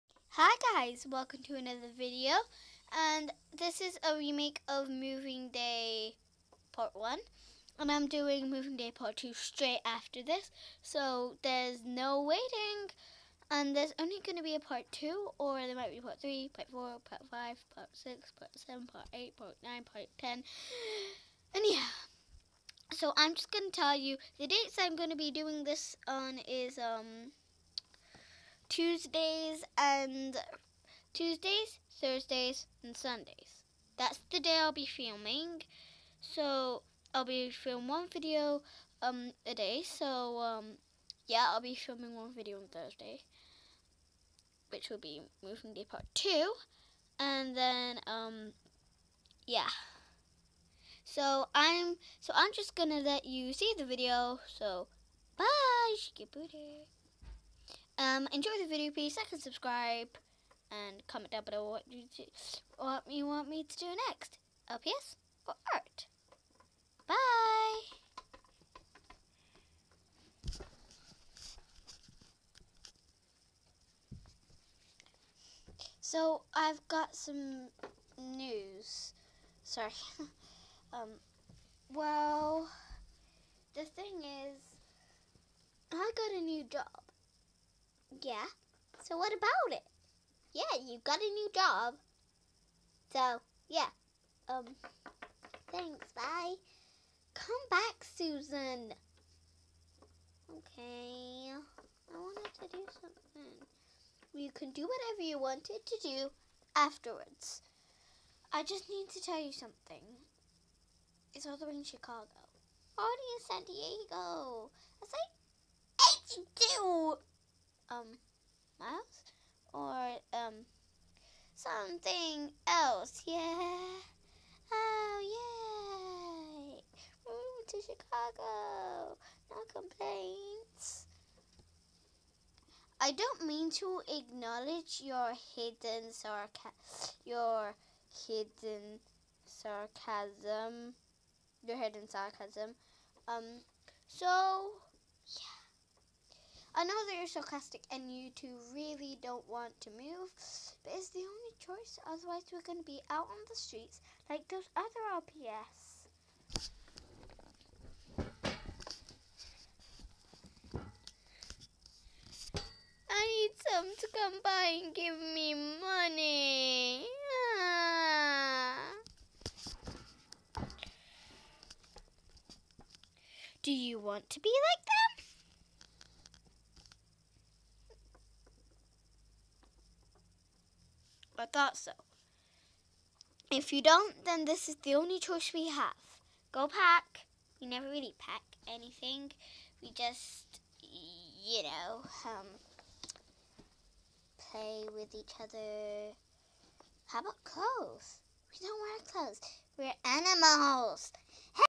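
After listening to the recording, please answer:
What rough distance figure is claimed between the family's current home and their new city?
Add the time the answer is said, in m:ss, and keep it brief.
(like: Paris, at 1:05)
82 miles, at 1:56.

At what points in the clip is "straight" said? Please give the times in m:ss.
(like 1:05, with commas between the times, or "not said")
0:09.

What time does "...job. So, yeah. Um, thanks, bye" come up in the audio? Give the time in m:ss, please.
1:31.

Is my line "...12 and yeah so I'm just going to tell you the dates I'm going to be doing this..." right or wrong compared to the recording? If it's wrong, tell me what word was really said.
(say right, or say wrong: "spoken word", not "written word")
wrong: "10", not "12".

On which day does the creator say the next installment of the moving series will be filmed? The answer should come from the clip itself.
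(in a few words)
Thursday.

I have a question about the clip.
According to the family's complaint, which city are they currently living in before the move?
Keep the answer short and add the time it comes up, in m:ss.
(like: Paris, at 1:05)
San Diego, at 1:53.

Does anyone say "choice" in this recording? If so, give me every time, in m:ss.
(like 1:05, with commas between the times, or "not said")
2:31, 3:05.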